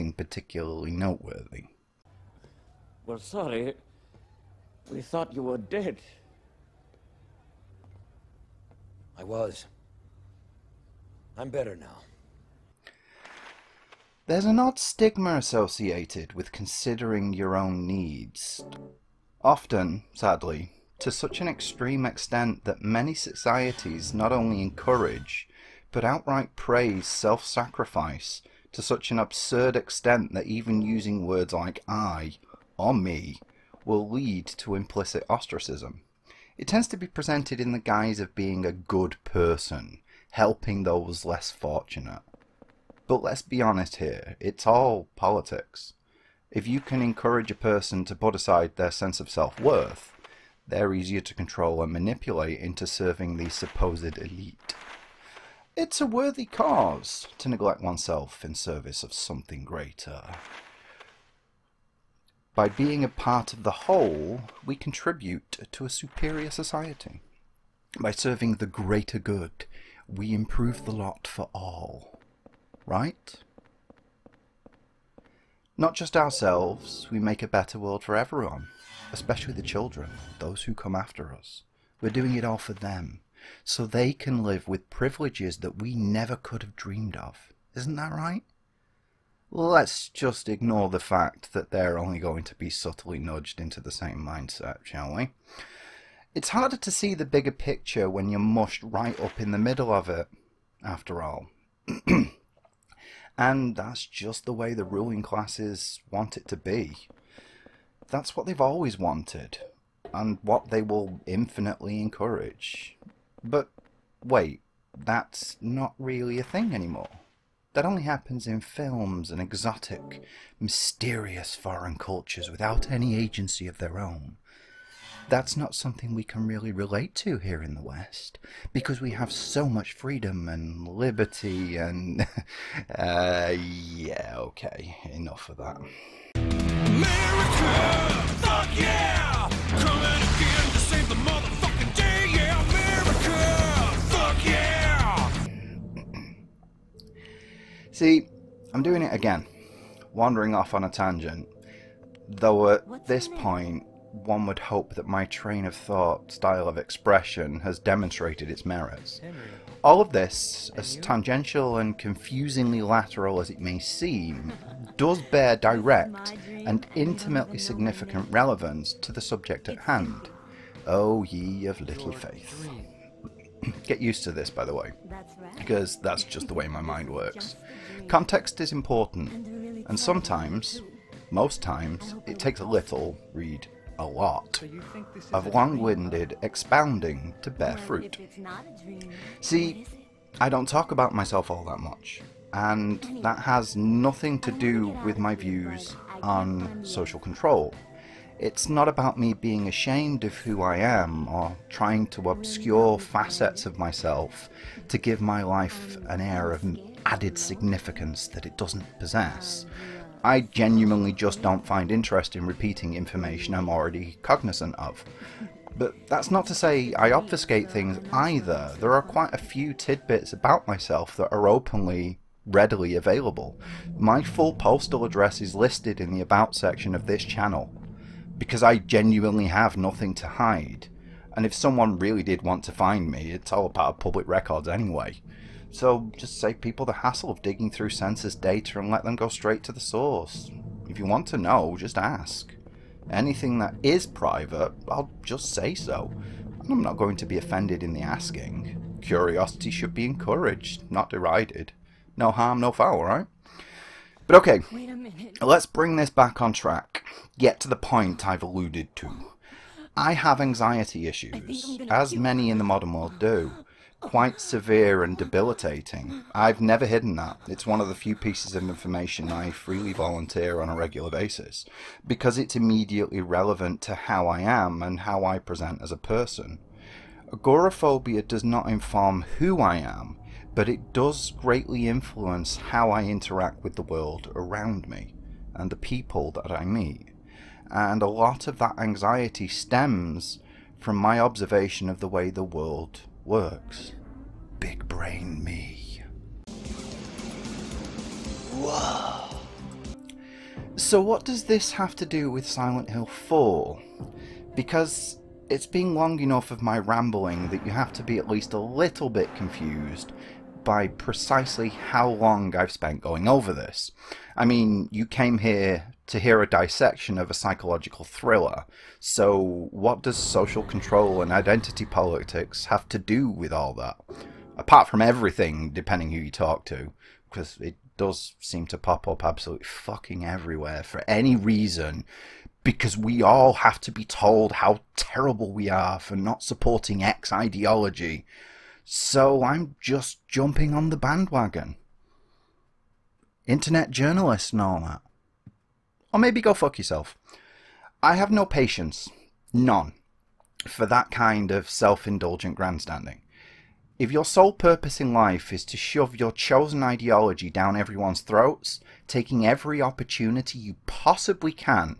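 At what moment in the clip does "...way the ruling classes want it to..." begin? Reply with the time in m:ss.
1:44.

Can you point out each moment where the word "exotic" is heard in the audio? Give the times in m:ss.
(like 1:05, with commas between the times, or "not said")
1:59.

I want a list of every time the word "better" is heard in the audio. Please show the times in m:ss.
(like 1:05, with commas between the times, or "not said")
0:11, 1:17.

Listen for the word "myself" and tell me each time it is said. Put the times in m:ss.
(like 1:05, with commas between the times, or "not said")
3:11, 3:23, 3:40.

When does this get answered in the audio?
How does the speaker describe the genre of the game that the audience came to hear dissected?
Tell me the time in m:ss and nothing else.
5:17.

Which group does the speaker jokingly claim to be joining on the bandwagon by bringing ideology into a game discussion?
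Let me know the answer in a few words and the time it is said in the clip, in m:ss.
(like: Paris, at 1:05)
Internet journalists, at 5:43.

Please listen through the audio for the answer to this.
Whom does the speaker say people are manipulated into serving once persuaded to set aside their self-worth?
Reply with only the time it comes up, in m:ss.
0:53.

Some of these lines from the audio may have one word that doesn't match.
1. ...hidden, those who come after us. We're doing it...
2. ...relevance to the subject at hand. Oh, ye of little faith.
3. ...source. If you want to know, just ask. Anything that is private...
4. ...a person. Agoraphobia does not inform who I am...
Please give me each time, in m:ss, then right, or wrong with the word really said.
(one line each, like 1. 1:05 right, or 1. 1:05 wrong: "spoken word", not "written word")
1. 1:19 wrong: "children", not "hidden"
2. 2:48 right
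3. 3:59 right
4. 4:35 right.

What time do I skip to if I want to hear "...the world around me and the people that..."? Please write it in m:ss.
4:43.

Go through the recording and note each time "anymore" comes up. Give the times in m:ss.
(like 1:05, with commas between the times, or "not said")
1:56.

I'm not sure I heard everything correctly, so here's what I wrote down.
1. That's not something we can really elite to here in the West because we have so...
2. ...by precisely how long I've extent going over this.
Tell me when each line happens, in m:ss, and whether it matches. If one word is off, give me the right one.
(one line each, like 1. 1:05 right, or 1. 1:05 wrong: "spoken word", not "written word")
1. 2:05 wrong: "relate", not "elite"
2. 5:10 wrong: "spent", not "extent".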